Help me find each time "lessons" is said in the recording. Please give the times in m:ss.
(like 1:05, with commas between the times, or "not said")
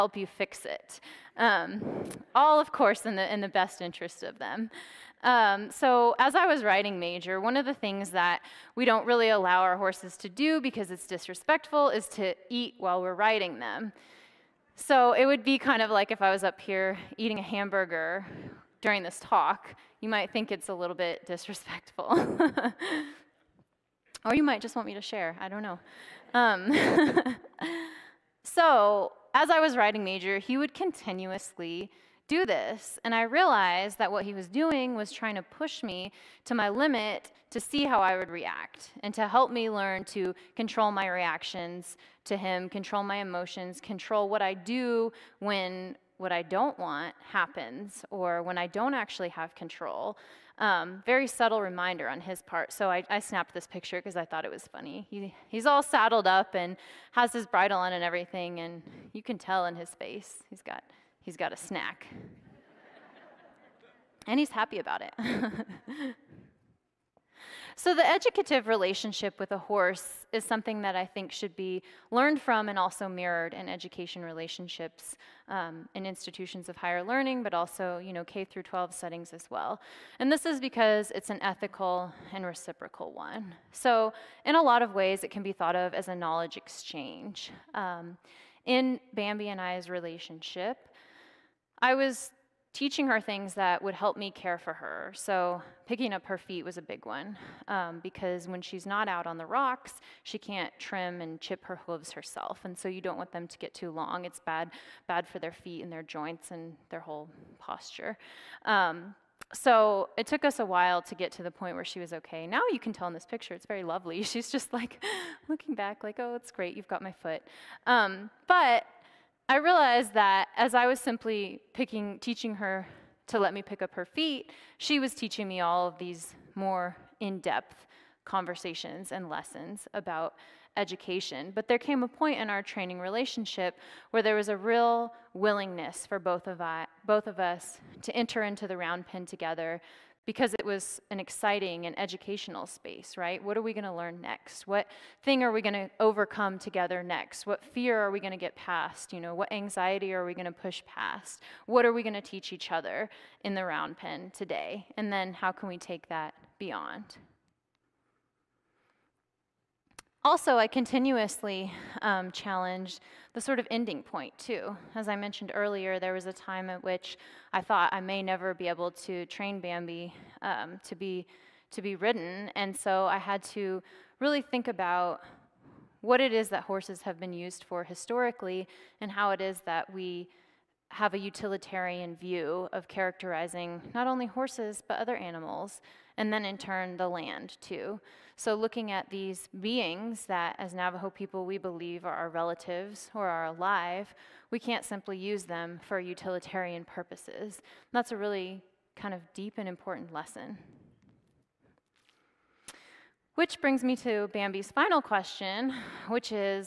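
2:09, 3:20.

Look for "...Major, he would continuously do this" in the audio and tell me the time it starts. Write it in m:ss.
0:30.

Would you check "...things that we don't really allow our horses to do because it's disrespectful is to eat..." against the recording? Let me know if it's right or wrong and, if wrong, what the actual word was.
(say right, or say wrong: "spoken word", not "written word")
right.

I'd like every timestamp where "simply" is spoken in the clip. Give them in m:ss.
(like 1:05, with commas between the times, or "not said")
2:00, 3:14.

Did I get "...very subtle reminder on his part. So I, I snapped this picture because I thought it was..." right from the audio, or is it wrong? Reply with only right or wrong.
right.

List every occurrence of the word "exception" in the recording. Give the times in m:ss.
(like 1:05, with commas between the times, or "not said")
not said.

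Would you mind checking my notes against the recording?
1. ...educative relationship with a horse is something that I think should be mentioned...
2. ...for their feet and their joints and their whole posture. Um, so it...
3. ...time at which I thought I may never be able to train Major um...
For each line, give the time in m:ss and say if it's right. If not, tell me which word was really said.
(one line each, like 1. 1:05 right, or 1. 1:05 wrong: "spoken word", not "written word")
1. 1:08 wrong: "learned", not "mentioned"
2. 1:45 right
3. 2:46 wrong: "Bambi", not "Major".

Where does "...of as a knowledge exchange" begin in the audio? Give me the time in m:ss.
1:25.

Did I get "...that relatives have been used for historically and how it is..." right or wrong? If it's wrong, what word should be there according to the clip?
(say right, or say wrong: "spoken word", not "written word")
wrong: "horses", not "relatives".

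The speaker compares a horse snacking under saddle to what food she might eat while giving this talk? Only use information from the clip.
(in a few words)
hamburger.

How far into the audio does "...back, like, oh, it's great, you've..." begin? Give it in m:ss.
1:55.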